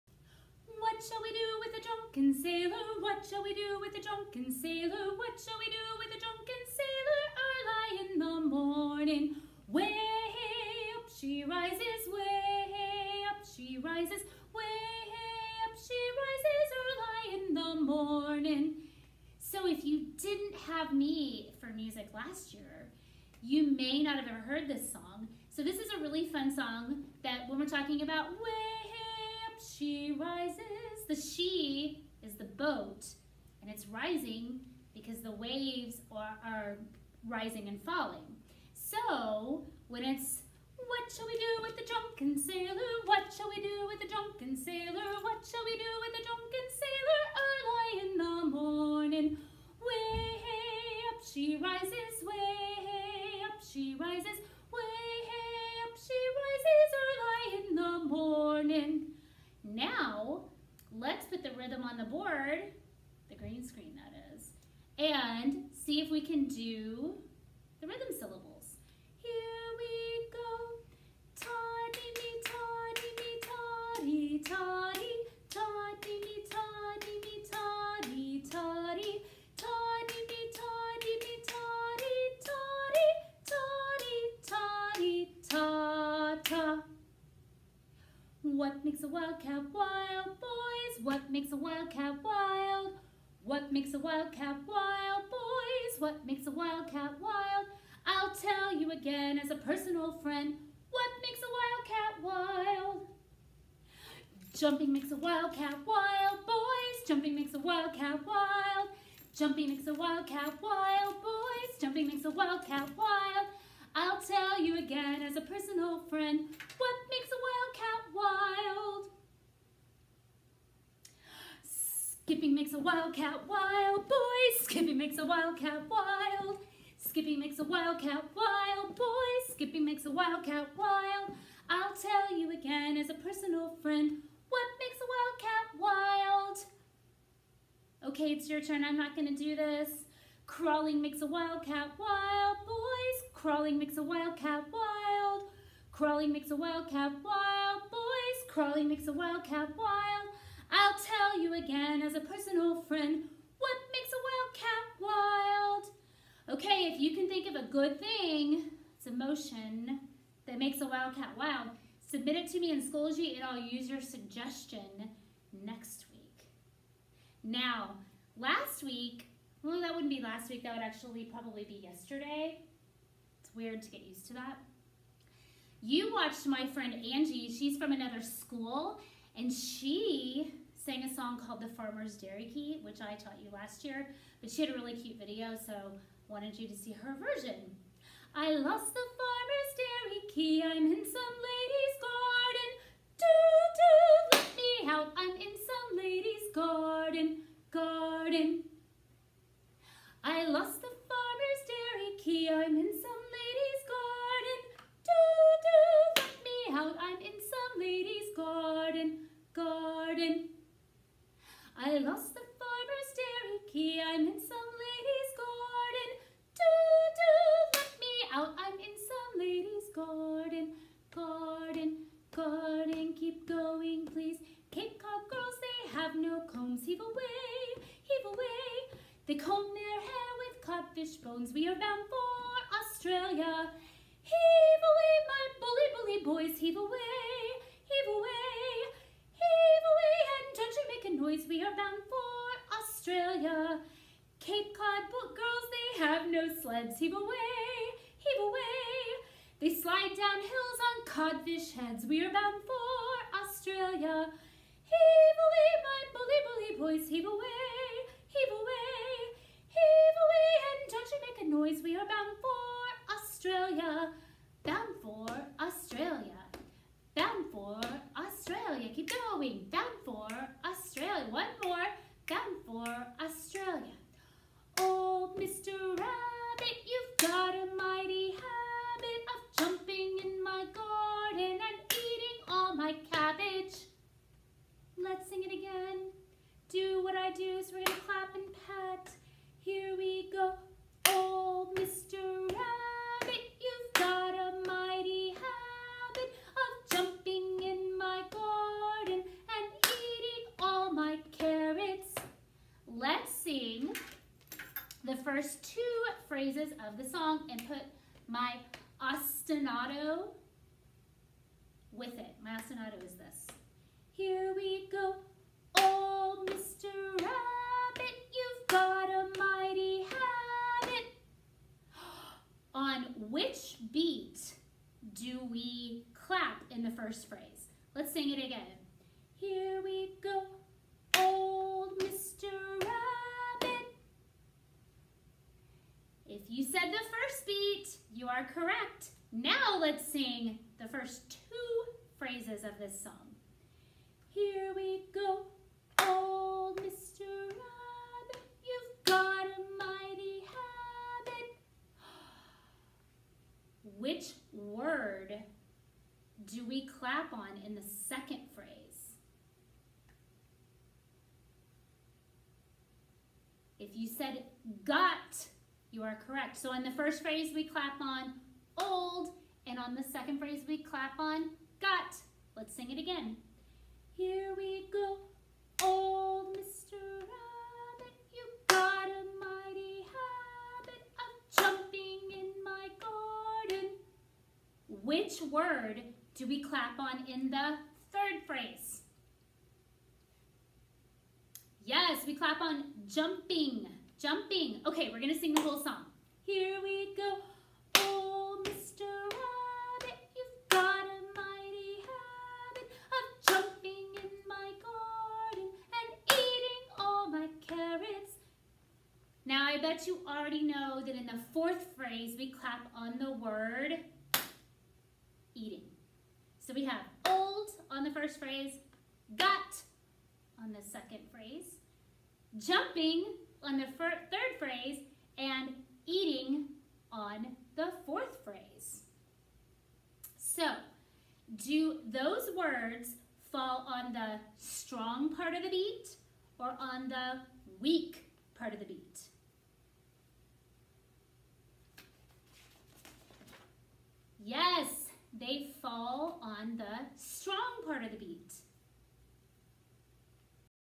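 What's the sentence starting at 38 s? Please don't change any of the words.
So when it's what shall we do with the drunken sailor?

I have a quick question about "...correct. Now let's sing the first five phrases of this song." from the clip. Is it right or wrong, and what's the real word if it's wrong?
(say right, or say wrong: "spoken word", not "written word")
wrong: "two", not "five".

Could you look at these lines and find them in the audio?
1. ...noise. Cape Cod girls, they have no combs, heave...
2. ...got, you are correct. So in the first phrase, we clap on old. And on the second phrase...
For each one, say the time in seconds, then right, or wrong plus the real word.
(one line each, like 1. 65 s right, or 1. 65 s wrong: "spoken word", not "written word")
1. 224 s wrong: "please", not "noise"
2. 364 s right.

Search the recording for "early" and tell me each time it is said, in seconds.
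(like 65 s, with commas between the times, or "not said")
7 s, 16 s.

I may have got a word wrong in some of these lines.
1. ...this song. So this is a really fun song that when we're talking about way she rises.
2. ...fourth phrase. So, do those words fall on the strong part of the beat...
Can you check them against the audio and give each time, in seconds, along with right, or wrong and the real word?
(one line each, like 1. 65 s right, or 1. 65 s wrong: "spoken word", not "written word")
1. 24 s right
2. 428 s right.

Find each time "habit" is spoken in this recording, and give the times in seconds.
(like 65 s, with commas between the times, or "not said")
295 s, 320 s, 351 s, 380 s.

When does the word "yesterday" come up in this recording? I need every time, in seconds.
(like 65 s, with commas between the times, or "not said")
171 s.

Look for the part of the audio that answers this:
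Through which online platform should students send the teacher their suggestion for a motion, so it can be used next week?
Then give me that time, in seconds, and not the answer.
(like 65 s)
162 s.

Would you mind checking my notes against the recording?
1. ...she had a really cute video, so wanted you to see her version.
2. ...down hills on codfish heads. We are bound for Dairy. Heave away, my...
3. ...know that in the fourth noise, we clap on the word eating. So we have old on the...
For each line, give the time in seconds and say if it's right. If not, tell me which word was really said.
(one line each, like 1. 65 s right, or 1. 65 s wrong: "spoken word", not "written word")
1. 184 s right
2. 250 s wrong: "Australia", not "Dairy"
3. 410 s wrong: "phrase", not "noise".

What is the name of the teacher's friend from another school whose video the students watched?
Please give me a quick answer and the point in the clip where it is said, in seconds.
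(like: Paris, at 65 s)
Angie, at 176 s.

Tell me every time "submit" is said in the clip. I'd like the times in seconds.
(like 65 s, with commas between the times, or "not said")
162 s.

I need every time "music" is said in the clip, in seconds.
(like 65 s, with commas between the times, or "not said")
21 s.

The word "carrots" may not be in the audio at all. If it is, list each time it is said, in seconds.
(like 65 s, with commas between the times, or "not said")
301 s.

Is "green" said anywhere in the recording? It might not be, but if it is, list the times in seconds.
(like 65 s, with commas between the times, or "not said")
63 s.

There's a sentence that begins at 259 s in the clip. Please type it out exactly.
Heave away, and don't you make a noise.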